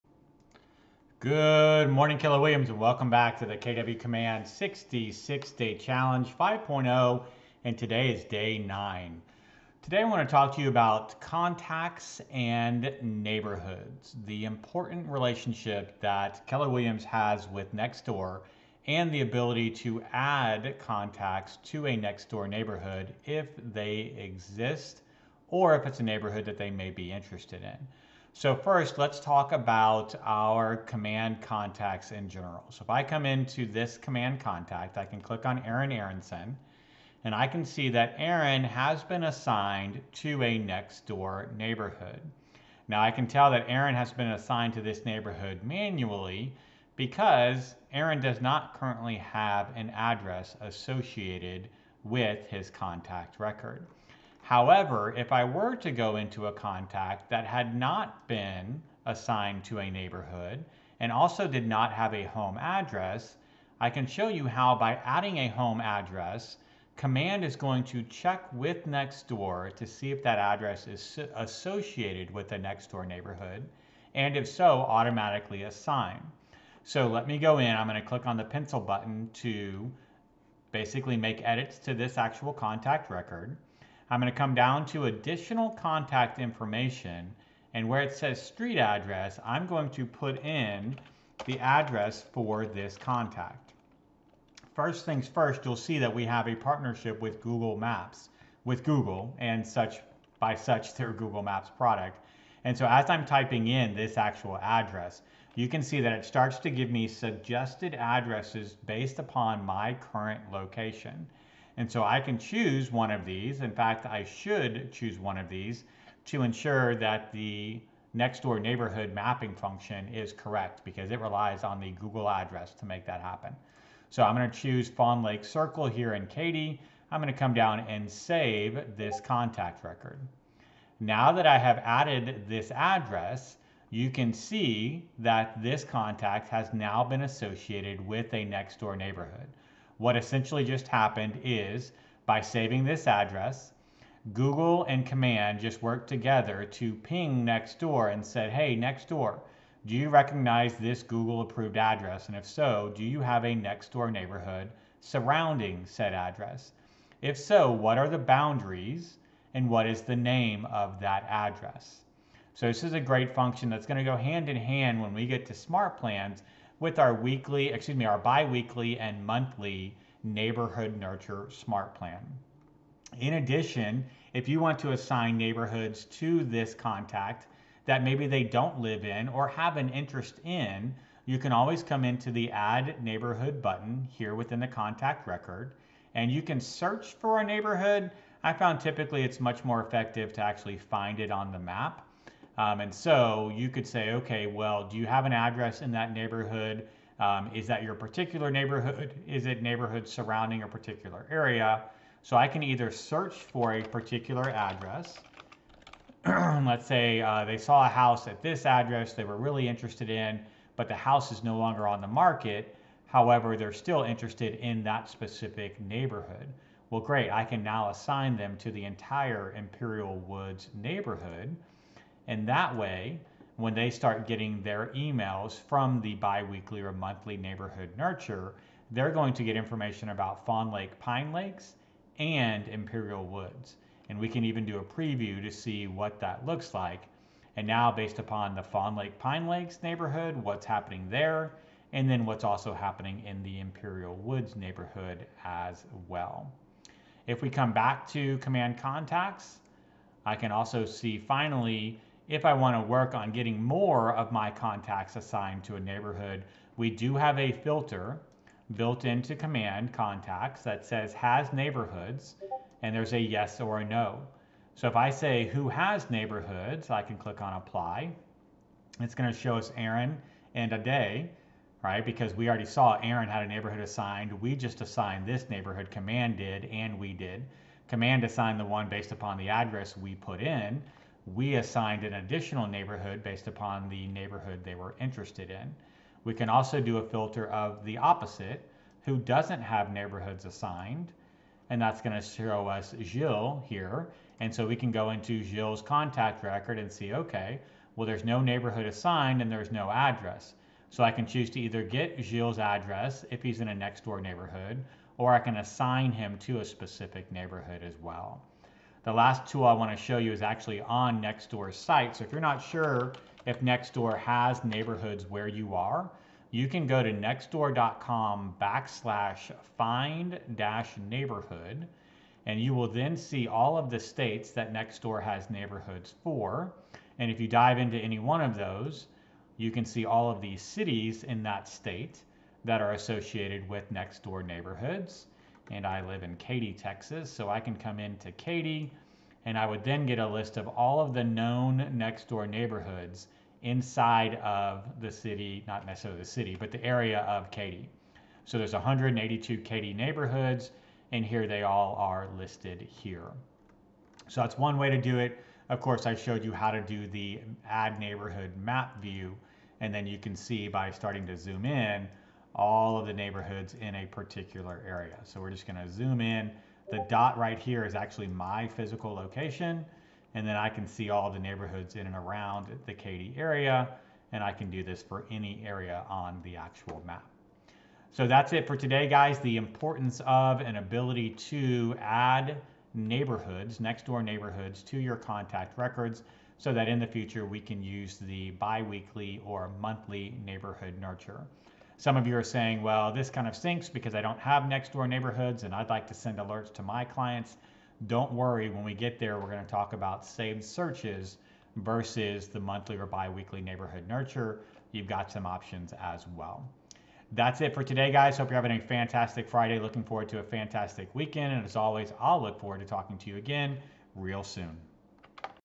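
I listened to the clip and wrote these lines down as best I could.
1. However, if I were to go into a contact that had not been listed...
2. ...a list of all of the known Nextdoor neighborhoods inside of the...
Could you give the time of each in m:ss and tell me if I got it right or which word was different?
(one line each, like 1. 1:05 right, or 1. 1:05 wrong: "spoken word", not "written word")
1. 0:54 wrong: "assigned", not "listed"
2. 5:40 right.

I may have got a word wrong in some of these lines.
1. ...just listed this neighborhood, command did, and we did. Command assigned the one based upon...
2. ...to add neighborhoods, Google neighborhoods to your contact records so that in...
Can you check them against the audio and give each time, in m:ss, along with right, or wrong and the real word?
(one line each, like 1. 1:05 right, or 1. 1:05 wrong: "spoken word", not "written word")
1. 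4:34 wrong: "assigned", not "listed"
2. 6:21 wrong: "Nextdoor", not "Google".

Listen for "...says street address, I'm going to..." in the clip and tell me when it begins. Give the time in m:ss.
1:28.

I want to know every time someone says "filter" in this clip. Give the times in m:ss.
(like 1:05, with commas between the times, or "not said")
4:17, 4:47.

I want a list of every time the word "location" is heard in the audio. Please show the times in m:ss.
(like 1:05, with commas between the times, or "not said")
1:50, 6:09.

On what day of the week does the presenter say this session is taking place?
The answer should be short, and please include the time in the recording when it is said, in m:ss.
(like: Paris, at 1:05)
Friday, at 6:49.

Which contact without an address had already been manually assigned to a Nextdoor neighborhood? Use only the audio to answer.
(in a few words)
Aaron Aronson.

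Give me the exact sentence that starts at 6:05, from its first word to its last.
So we're just gonna zoom in.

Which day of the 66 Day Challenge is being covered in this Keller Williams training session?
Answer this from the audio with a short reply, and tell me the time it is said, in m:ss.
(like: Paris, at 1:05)
Day 9, at 0:08.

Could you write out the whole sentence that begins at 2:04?
So I'm going to choose Fawn Lake Circle here in Katy.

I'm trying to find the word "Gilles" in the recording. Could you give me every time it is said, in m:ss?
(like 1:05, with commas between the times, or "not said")
4:53.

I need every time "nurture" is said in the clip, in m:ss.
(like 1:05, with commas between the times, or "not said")
2:50, 3:47, 6:30, 6:44.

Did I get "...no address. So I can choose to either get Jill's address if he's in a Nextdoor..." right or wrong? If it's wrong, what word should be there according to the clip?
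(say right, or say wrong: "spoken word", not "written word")
right.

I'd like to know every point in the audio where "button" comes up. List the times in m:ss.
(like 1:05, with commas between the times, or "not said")
1:18, 3:03.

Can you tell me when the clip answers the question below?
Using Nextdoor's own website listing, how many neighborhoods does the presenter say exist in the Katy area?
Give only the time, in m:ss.
5:48.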